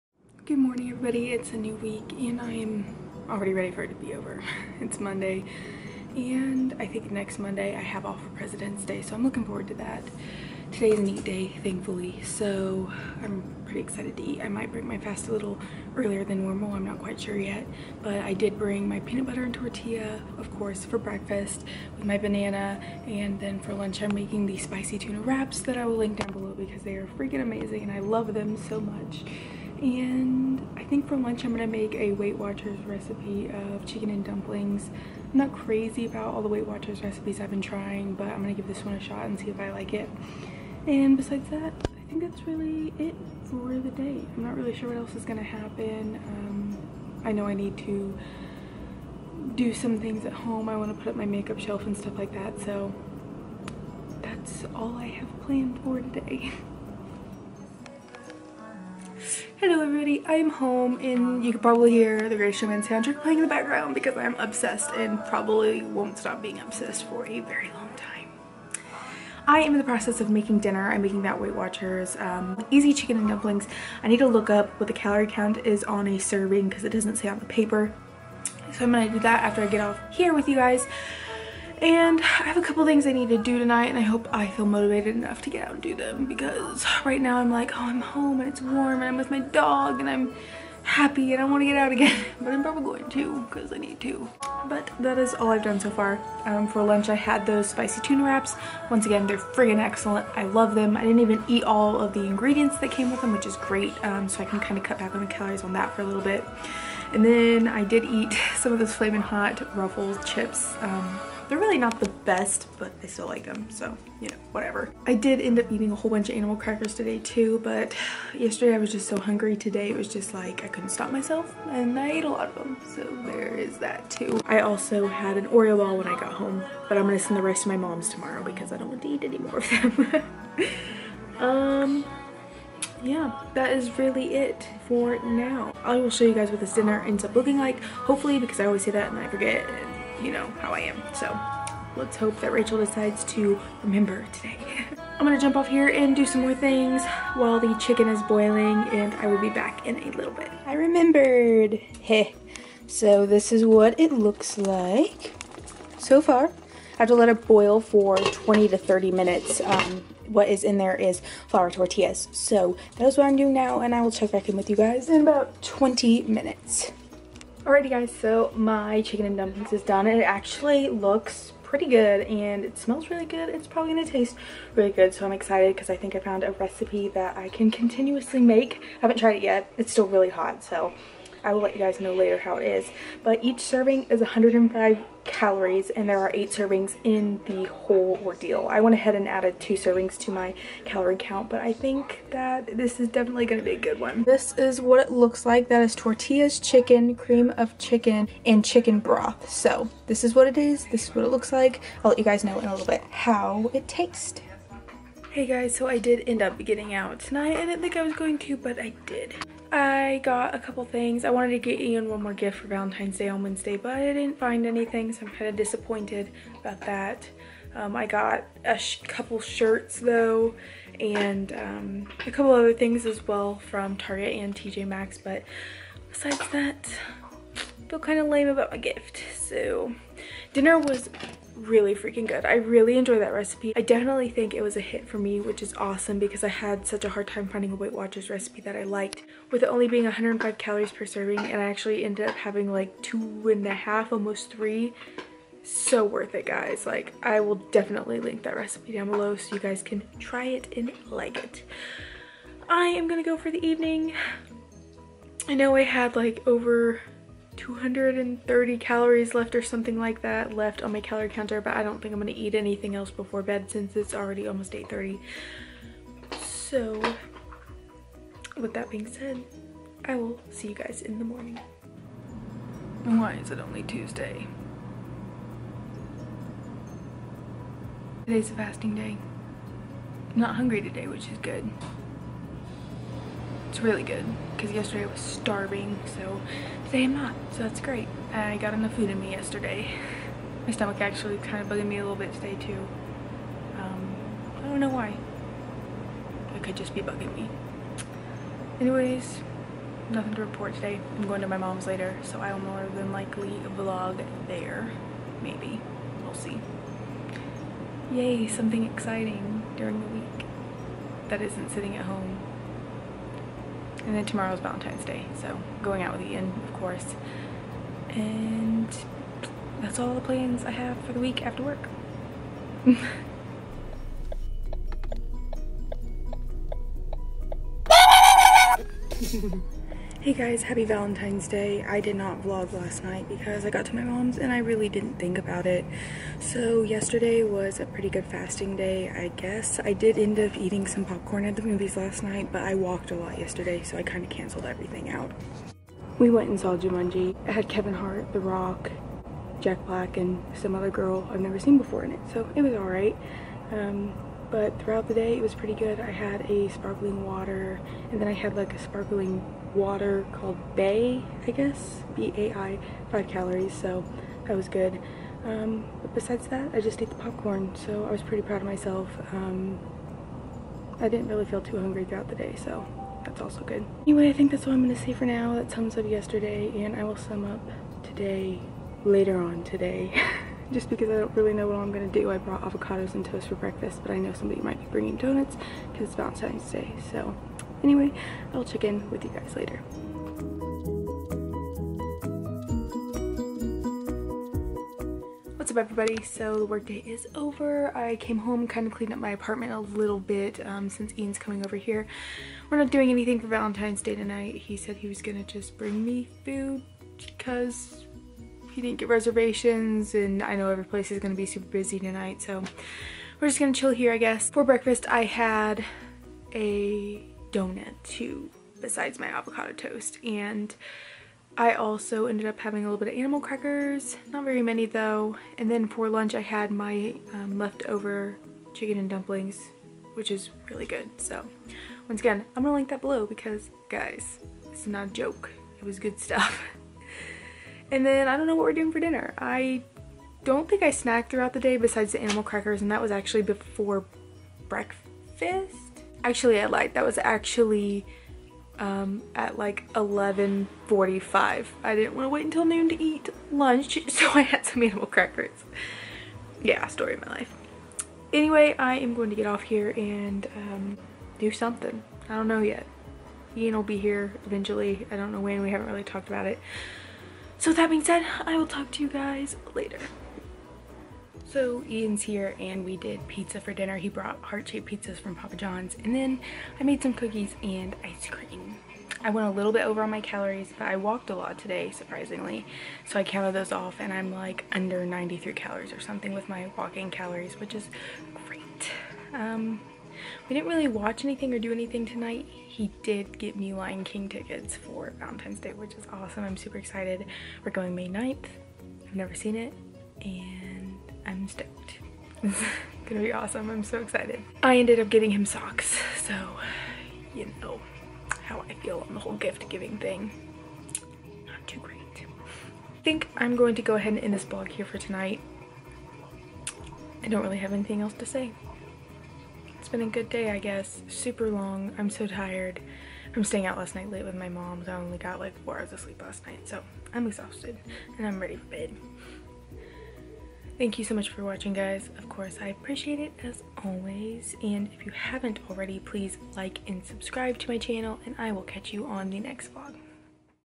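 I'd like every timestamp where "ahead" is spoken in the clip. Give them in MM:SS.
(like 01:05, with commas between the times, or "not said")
03:08, 08:33.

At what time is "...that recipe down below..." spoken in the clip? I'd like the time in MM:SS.
04:08.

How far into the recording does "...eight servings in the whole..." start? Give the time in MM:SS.
03:06.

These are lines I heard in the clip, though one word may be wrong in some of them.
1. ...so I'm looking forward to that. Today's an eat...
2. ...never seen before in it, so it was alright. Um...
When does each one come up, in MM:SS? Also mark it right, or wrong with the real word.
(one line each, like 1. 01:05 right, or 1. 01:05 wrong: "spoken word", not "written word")
1. 00:09 right
2. 05:51 right.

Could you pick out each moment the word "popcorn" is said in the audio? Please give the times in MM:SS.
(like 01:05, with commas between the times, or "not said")
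05:41, 06:07.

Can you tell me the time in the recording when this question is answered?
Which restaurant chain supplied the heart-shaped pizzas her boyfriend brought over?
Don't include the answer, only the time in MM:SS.
07:55.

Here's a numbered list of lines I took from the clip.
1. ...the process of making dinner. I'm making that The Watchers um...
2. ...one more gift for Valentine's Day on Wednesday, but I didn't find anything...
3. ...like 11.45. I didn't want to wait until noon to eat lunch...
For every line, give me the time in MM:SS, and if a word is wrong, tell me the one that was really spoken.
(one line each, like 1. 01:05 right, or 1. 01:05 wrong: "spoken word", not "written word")
1. 01:09 wrong: "Weight", not "The"
2. 03:32 right
3. 07:29 right.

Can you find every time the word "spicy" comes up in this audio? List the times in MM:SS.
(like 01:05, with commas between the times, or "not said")
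00:24, 01:37.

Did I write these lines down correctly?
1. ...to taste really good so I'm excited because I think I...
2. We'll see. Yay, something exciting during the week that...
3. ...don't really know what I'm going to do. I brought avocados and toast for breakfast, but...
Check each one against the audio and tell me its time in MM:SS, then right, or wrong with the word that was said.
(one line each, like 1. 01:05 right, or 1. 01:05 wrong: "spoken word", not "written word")
1. 02:54 right
2. 05:06 right
3. 06:21 right.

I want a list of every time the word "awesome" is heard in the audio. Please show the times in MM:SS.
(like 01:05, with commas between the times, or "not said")
03:55, 08:16, 08:23.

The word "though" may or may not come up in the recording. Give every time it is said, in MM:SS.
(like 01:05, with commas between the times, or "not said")
03:40, 07:04.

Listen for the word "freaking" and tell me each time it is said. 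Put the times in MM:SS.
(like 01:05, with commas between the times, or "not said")
00:27, 03:51.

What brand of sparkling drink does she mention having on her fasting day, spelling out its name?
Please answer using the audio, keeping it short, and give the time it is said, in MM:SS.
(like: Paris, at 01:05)
Bai, at 06:02.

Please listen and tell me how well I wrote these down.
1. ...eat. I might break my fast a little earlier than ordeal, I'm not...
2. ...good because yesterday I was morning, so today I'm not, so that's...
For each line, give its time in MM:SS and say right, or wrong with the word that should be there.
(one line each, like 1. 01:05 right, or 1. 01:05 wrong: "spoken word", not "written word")
1. 00:14 wrong: "normal", not "ordeal"
2. 04:44 wrong: "starving", not "morning".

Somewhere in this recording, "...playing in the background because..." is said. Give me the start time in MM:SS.
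01:03.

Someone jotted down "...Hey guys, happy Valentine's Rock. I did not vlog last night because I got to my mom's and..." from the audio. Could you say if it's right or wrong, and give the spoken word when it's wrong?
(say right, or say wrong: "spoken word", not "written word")
wrong: "Day", not "Rock".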